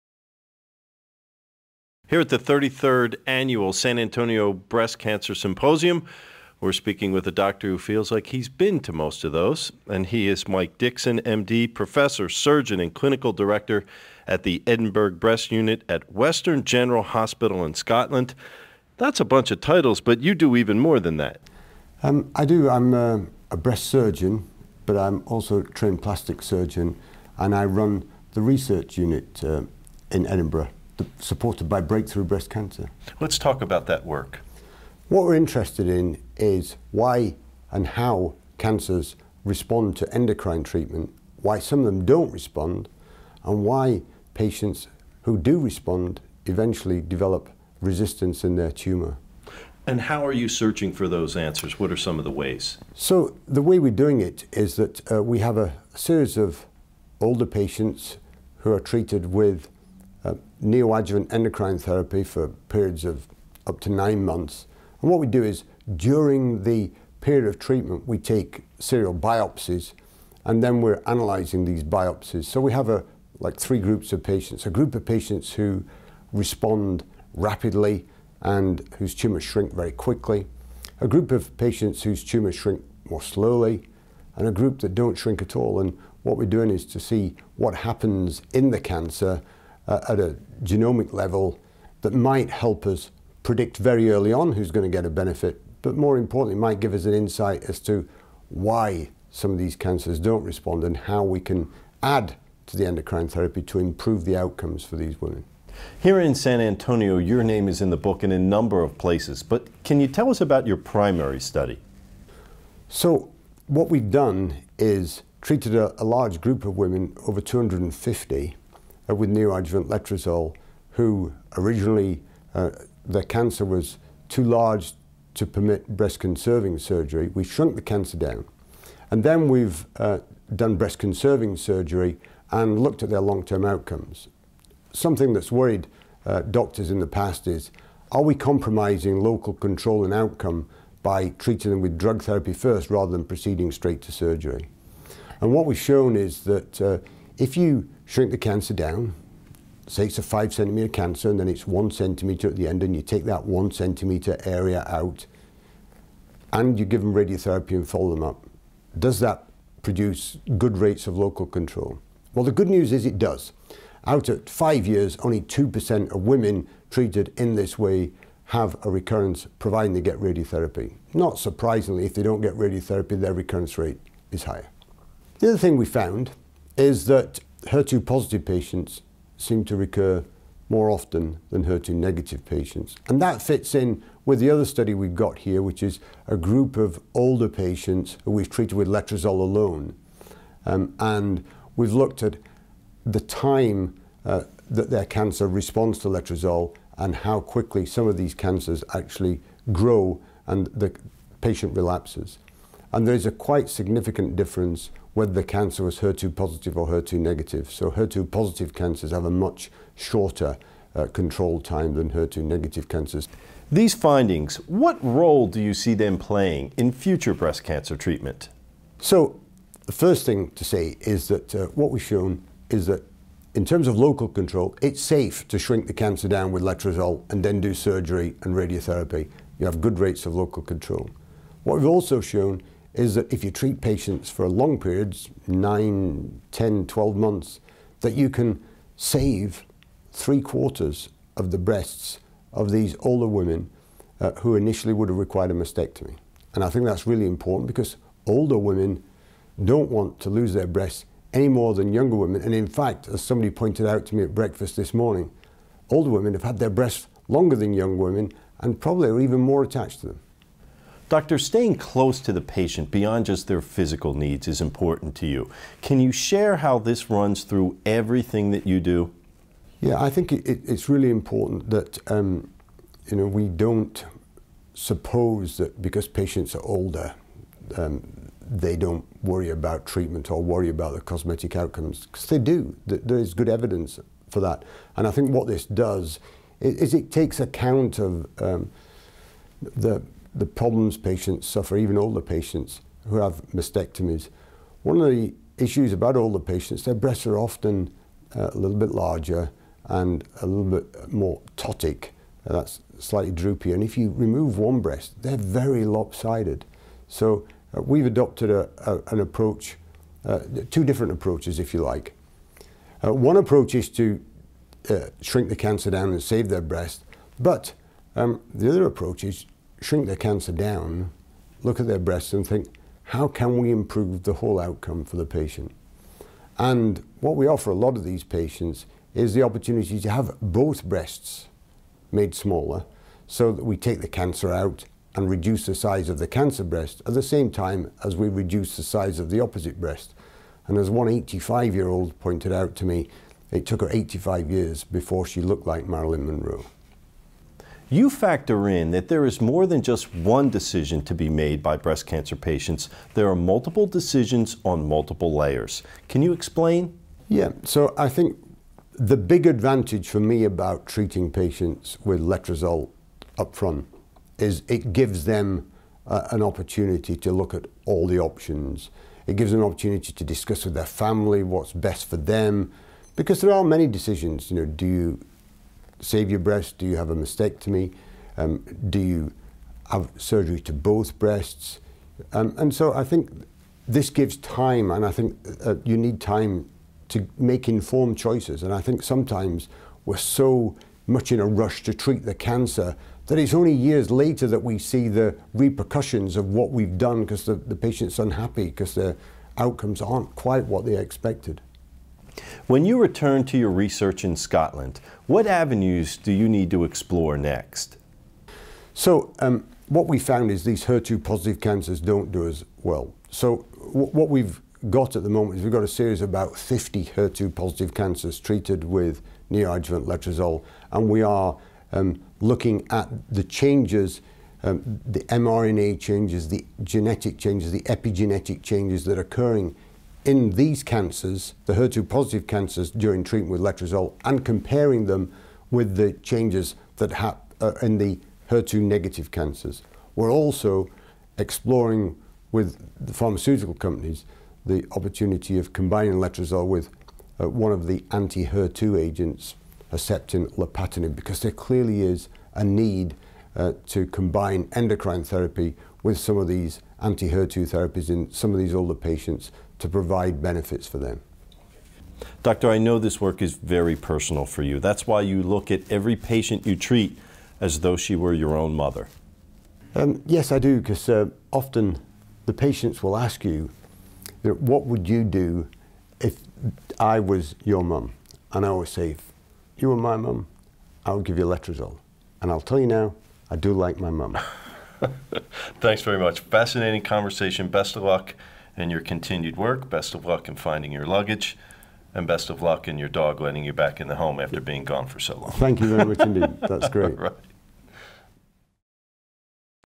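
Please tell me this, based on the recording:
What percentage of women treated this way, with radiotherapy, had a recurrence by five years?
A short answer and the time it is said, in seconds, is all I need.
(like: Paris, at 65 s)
2%, at 165 s.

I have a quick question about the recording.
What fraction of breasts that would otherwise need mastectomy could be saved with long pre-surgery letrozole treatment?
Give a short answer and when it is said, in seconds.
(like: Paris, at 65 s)
three quarters, at 240 s.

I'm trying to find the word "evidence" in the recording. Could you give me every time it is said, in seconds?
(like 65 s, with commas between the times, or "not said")
283 s.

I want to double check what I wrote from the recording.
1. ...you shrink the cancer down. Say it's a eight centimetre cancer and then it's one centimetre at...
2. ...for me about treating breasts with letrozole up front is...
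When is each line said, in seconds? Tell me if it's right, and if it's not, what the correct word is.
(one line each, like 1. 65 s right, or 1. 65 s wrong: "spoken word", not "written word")
1. 147 s wrong: "five", not "eight"
2. 360 s wrong: "patients", not "breasts".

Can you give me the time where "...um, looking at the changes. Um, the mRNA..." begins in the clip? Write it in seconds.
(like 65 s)
421 s.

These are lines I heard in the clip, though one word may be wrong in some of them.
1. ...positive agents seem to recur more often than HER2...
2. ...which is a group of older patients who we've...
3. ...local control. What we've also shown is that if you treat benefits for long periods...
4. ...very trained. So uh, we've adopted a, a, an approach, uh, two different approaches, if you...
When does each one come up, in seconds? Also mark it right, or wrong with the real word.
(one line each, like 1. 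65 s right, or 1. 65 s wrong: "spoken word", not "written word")
1. 178 s wrong: "patients", not "agents"
2. 185 s right
3. 230 s wrong: "patients", not "benefits"
4. 305 s wrong: "lopsided", not "trained".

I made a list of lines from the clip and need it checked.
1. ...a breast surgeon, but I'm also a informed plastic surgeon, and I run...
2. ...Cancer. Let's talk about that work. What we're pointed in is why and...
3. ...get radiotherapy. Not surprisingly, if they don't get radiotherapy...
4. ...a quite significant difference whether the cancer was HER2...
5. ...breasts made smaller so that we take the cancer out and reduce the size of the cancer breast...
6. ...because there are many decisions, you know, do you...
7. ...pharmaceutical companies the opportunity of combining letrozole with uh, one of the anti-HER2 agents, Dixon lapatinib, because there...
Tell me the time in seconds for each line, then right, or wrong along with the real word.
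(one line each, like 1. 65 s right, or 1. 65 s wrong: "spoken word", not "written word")
1. 23 s wrong: "trained", not "informed"
2. 32 s wrong: "interested", not "pointed"
3. 170 s right
4. 203 s right
5. 330 s right
6. 373 s right
7. 443 s wrong: "Herceptin", not "Dixon".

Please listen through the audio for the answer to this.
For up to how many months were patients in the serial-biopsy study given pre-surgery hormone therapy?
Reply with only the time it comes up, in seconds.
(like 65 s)
63 s.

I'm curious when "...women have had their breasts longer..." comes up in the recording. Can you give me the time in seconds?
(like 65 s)
256 s.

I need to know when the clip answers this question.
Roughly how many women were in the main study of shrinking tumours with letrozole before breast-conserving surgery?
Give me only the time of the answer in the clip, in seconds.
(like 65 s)
117 s.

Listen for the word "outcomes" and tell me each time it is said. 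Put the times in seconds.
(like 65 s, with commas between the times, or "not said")
104 s, 133 s, 140 s, 281 s, 324 s, 399 s.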